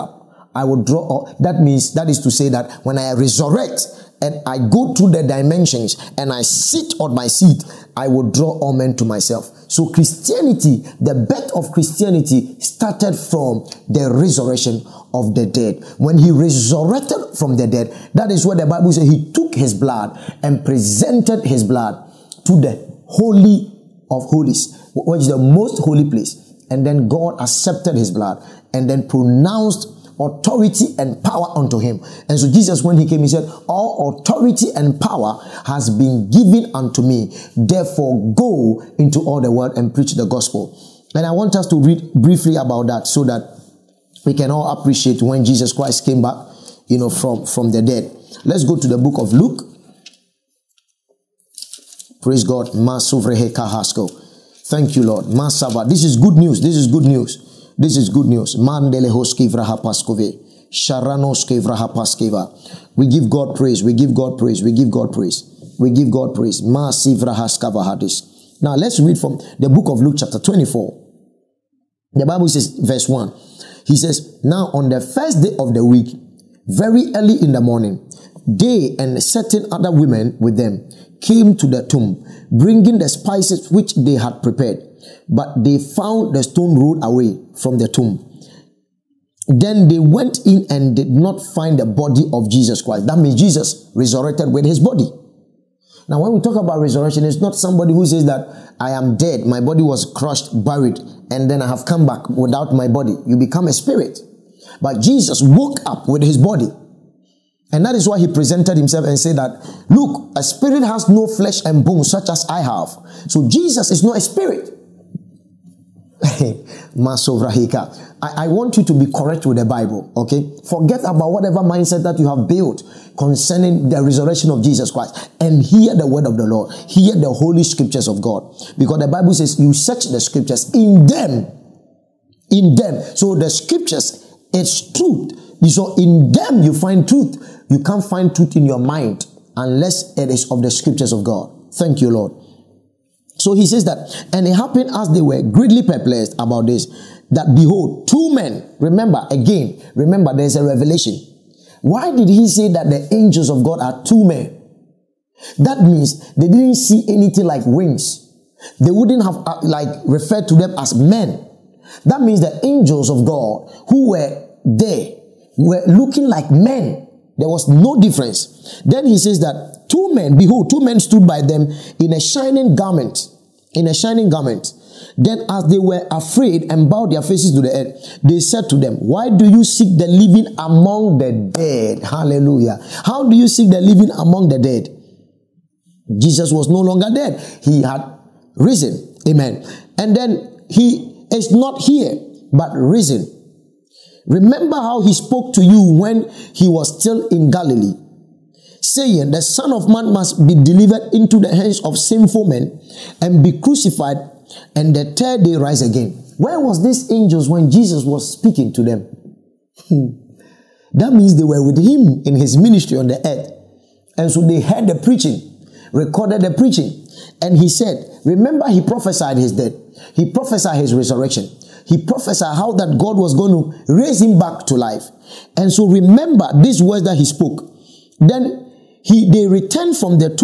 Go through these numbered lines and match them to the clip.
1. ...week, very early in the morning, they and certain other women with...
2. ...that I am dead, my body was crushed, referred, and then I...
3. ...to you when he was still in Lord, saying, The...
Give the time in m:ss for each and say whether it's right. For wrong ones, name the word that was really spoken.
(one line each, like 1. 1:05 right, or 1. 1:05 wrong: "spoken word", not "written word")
1. 1:15 right
2. 1:38 wrong: "buried", not "referred"
3. 3:15 wrong: "Galilee", not "Lord".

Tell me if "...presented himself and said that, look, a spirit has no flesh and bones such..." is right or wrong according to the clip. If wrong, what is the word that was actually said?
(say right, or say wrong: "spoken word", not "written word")
right.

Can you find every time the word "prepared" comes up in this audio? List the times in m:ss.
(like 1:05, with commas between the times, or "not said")
1:24.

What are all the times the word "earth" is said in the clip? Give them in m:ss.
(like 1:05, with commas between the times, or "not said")
2:57, 3:33.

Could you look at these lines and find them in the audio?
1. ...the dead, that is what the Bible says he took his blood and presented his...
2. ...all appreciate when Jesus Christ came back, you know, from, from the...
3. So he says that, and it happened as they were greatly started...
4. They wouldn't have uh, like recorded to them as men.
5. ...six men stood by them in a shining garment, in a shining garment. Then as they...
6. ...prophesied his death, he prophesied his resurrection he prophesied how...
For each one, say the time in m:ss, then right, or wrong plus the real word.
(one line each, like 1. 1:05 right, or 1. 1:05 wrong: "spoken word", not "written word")
1. 0:17 right
2. 0:44 right
3. 2:23 wrong: "perplexed", not "started"
4. 2:38 wrong: "referred", not "recorded"
5. 2:50 wrong: "two", not "six"
6. 3:38 right.